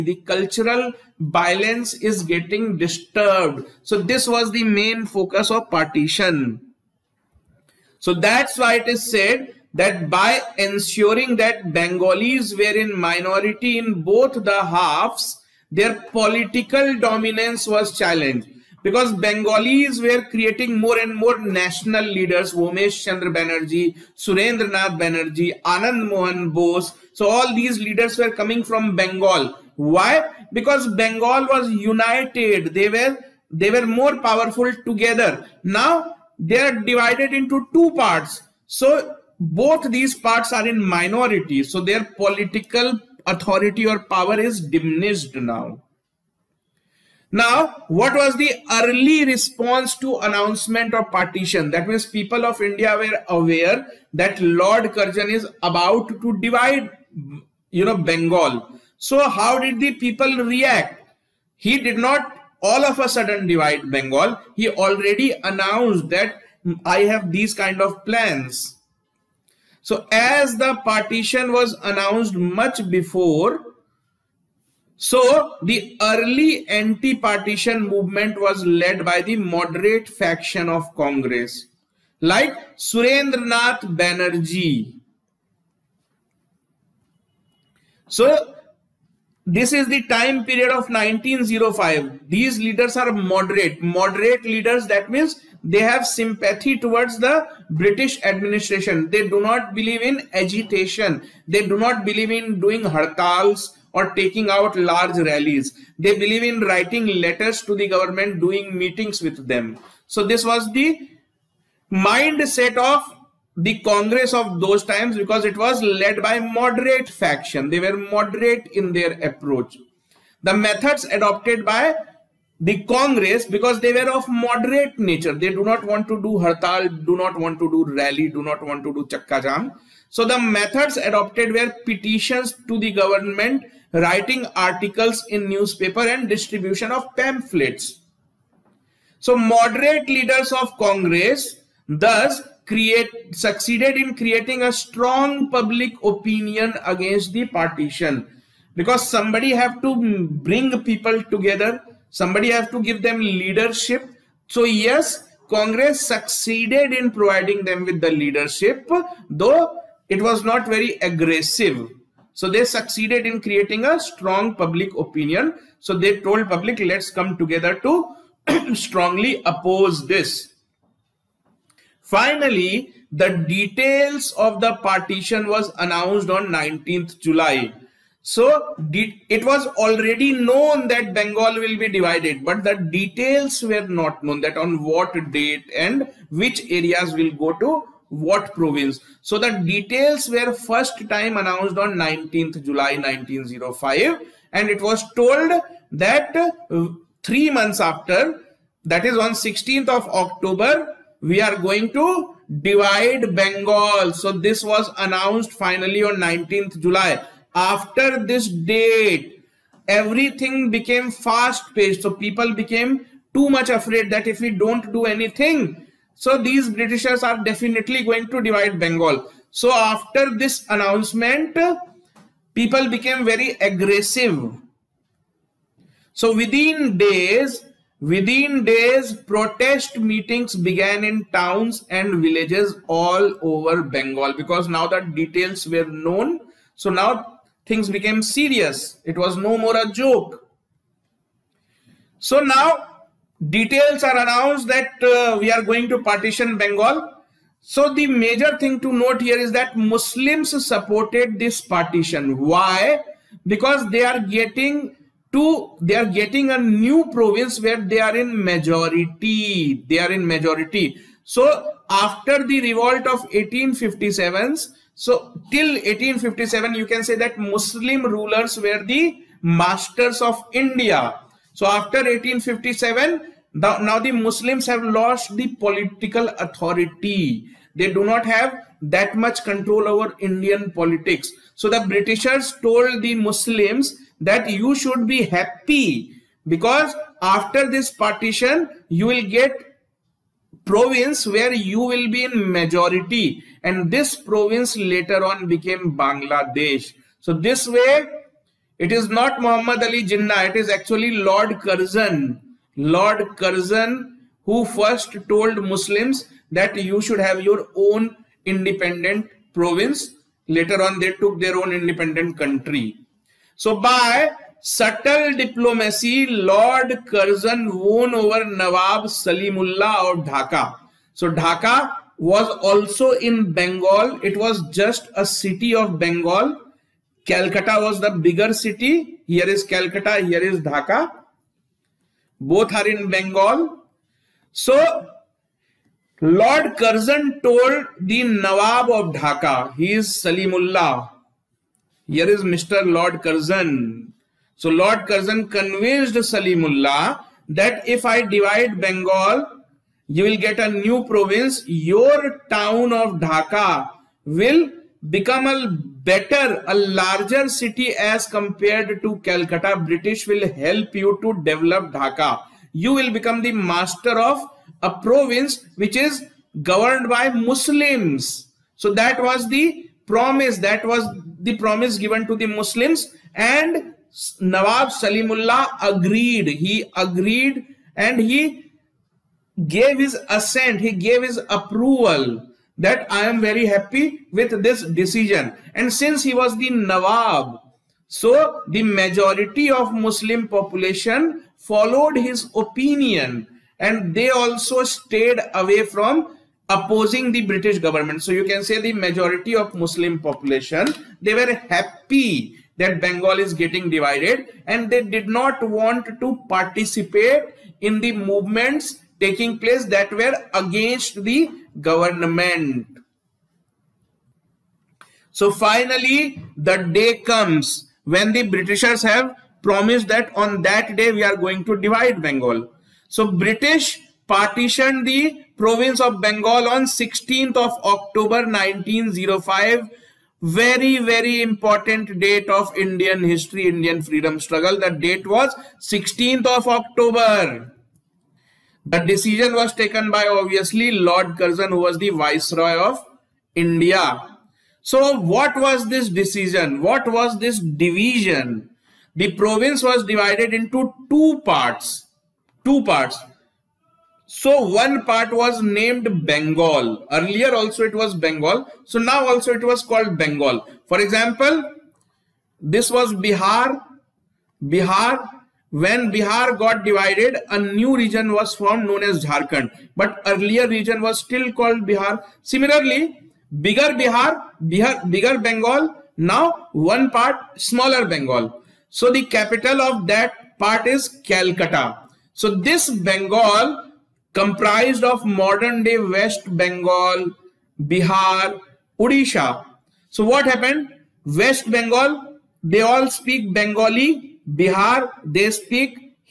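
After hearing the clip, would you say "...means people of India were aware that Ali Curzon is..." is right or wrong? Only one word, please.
wrong.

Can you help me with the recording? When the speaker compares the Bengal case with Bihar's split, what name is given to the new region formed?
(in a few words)
Jharkhand.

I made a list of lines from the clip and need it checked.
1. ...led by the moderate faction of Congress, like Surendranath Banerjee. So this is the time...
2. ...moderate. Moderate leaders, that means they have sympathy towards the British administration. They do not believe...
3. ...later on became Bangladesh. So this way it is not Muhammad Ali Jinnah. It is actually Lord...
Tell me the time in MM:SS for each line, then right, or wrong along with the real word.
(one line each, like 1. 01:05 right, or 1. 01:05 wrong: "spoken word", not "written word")
1. 01:18 right
2. 01:33 right
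3. 04:54 right.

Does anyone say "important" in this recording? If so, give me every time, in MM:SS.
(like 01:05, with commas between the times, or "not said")
07:11.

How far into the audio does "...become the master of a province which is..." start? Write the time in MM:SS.
06:03.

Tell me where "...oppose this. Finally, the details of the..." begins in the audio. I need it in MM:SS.
02:49.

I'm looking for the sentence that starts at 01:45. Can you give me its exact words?
They believe in writing letters to the government, doing meetings with them.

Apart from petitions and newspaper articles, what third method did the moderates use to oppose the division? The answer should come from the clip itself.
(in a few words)
distribution of pamphlets.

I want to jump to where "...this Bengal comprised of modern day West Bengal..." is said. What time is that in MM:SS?
08:02.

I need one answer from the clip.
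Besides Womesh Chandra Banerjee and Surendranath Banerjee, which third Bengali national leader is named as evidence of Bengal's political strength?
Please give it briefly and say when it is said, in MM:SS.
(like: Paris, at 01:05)
Anand Mohan Bose, at 00:25.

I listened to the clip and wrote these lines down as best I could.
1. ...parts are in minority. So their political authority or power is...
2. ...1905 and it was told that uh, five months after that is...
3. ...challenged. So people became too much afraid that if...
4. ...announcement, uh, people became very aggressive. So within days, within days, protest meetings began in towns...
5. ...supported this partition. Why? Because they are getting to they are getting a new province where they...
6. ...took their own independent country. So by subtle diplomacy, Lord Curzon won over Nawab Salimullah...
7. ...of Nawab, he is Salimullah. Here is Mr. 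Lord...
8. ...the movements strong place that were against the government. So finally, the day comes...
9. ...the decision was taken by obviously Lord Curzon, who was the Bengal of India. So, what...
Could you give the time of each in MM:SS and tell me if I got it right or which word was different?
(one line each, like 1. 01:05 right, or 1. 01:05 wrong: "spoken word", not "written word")
1. 00:40 right
2. 03:12 wrong: "three", not "five"
3. 03:31 wrong: "paced", not "challenged"
4. 03:40 right
5. 04:10 right
6. 05:11 right
7. 05:38 wrong: "Dhaka", not "Nawab"
8. 06:47 wrong: "taking", not "strong"
9. 07:18 wrong: "Viceroy", not "Bengal".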